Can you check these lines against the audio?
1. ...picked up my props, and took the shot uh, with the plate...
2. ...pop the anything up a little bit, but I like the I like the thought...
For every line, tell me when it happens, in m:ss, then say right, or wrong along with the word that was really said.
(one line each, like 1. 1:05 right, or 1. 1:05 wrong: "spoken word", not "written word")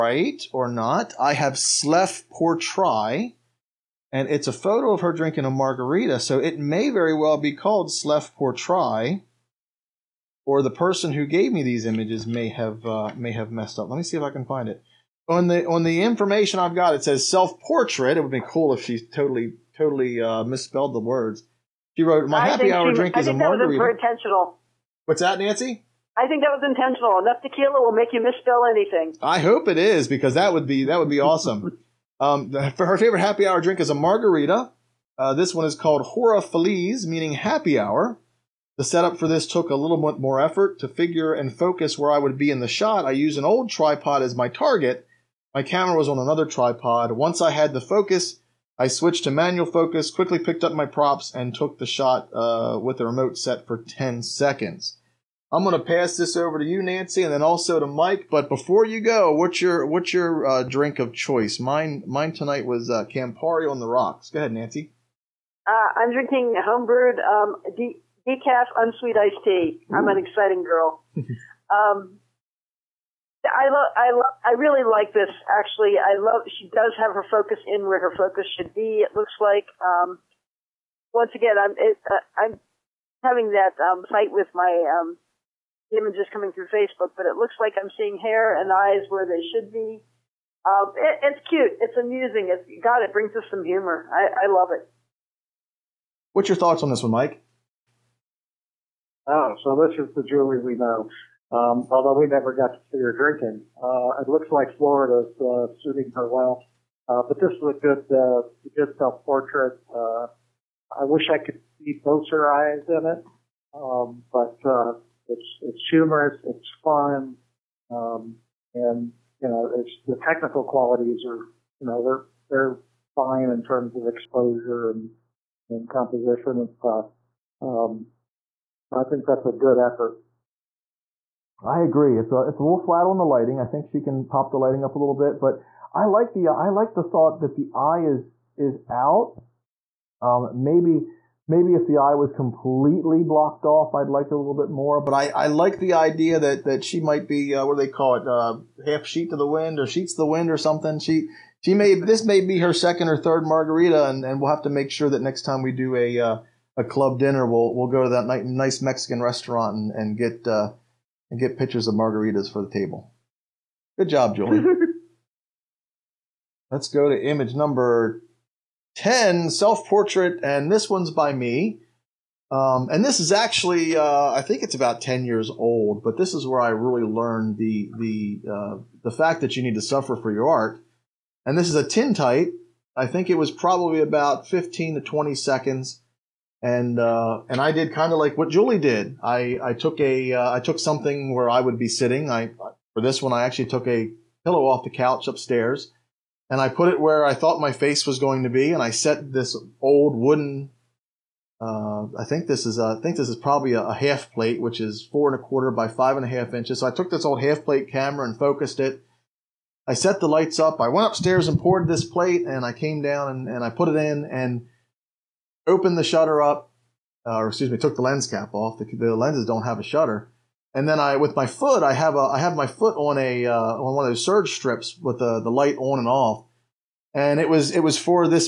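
1. 0:50 wrong: "remote", not "plate"
2. 2:14 wrong: "lighting", not "anything".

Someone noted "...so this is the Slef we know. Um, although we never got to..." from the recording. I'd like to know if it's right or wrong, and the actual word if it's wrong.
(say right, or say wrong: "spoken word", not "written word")
wrong: "Julie", not "Slef".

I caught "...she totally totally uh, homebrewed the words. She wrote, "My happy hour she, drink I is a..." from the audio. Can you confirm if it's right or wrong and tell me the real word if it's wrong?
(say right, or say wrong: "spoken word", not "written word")
wrong: "misspelled", not "homebrewed".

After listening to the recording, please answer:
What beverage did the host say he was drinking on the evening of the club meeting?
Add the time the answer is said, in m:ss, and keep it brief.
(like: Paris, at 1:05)
Campari on the rocks, at 1:03.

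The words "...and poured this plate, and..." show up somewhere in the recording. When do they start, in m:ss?
3:31.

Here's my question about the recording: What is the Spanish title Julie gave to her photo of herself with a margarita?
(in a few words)
Hora Feliz.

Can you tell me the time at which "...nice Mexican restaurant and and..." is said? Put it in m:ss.
2:38.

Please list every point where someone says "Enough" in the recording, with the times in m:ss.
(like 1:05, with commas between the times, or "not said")
0:27.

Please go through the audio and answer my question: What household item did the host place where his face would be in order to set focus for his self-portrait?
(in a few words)
A pillow.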